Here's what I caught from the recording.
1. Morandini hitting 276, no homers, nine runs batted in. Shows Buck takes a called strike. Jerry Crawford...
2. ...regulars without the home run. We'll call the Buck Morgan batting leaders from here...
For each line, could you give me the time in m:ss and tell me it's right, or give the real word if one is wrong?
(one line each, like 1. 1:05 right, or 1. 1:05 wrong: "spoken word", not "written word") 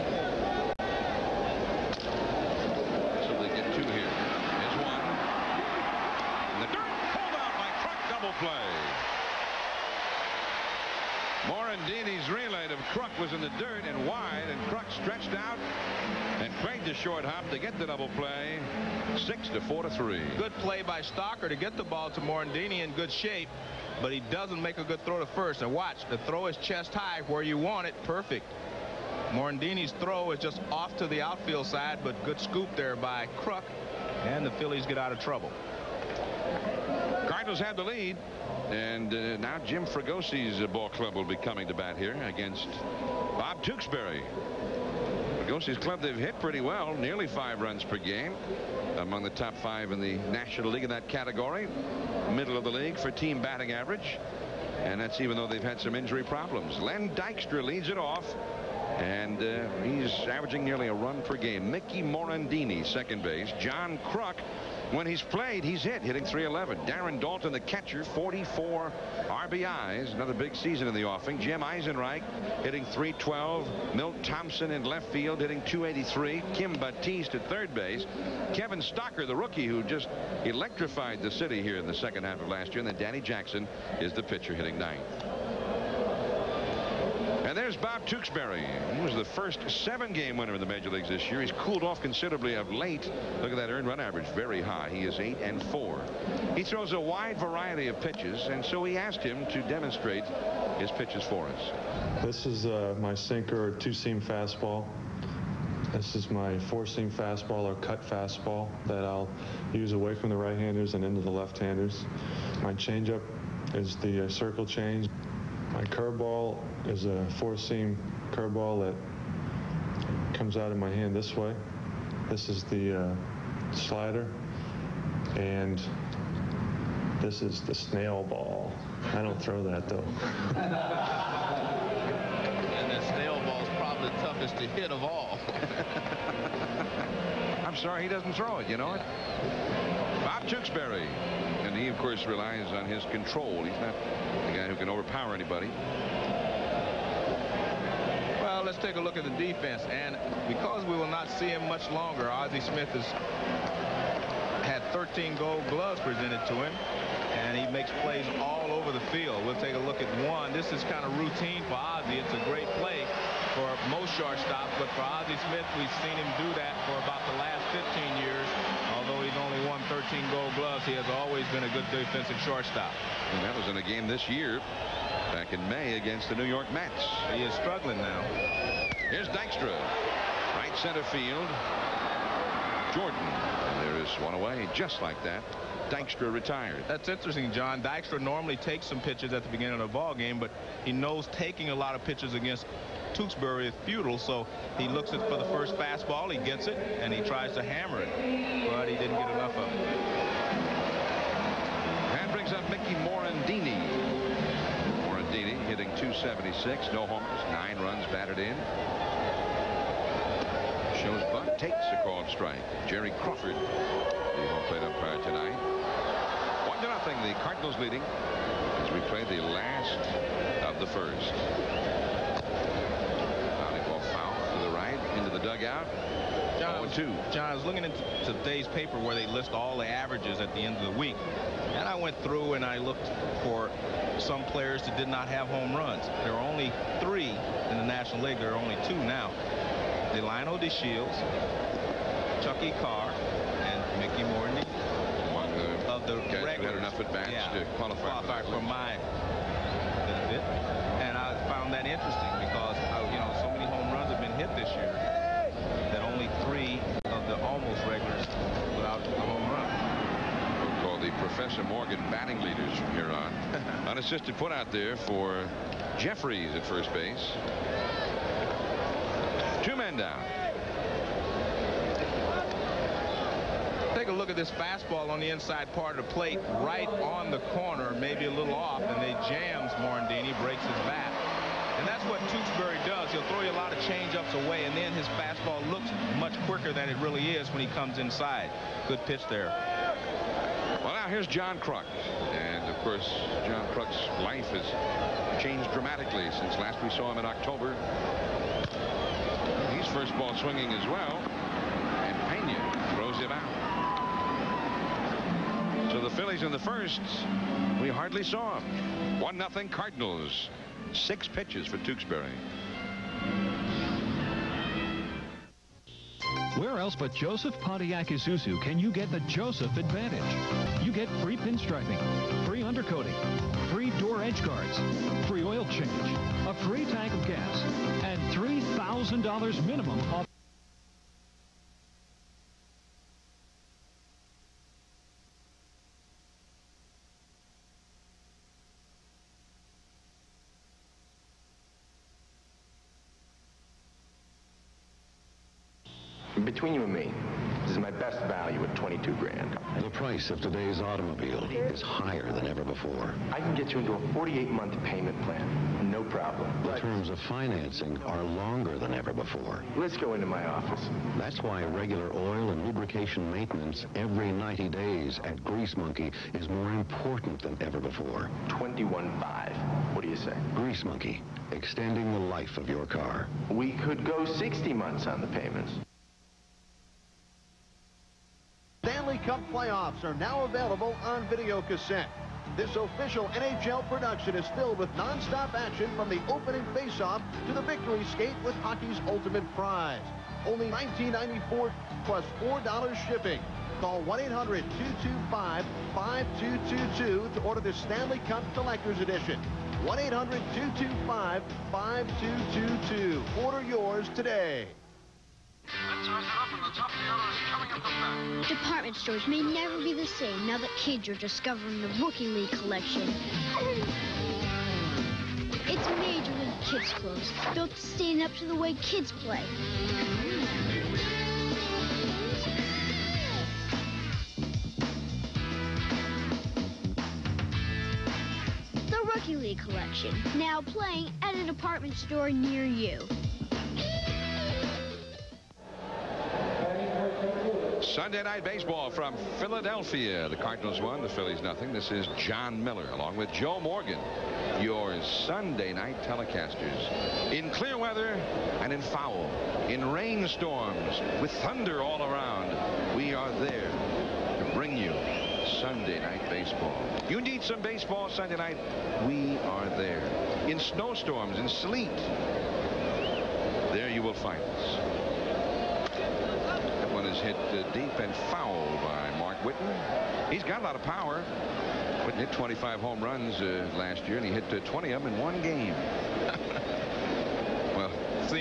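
1. 3:25 right
2. 4:17 wrong: "Professor", not "Buck".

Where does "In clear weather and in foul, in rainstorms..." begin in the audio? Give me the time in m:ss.
7:27.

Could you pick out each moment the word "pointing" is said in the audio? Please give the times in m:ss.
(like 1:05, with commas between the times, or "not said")
not said.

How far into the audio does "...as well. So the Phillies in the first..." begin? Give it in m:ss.
5:00.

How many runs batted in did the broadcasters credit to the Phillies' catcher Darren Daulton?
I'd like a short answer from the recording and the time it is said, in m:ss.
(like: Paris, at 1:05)
44, at 1:08.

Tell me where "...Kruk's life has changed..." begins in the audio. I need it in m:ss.
4:53.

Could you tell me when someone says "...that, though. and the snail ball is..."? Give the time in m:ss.
2:09.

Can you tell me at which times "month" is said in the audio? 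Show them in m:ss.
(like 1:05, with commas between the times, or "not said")
5:54, 6:14.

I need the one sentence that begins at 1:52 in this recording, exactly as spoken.
My changeup is the uh, circle change.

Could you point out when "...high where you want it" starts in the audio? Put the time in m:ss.
0:26.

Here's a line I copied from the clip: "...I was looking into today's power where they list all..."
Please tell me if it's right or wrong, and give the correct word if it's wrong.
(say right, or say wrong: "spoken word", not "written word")
wrong: "paper", not "power".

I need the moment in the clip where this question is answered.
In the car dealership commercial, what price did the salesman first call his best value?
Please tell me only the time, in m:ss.
5:48.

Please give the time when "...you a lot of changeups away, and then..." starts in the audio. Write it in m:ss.
4:43.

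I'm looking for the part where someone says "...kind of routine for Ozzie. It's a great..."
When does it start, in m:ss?
2:40.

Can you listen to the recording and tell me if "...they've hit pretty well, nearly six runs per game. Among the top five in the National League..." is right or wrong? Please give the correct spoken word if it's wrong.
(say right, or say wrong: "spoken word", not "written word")
wrong: "five", not "six".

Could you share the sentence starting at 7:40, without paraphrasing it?
In snowstorms, in sleet, there you will find us is hit uh, deep and foul by Mark Whiten.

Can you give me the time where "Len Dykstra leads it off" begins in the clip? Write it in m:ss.
0:56.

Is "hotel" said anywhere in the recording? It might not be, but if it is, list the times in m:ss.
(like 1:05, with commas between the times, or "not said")
not said.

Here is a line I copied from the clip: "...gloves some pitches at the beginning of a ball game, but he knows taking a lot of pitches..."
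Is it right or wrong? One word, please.
wrong.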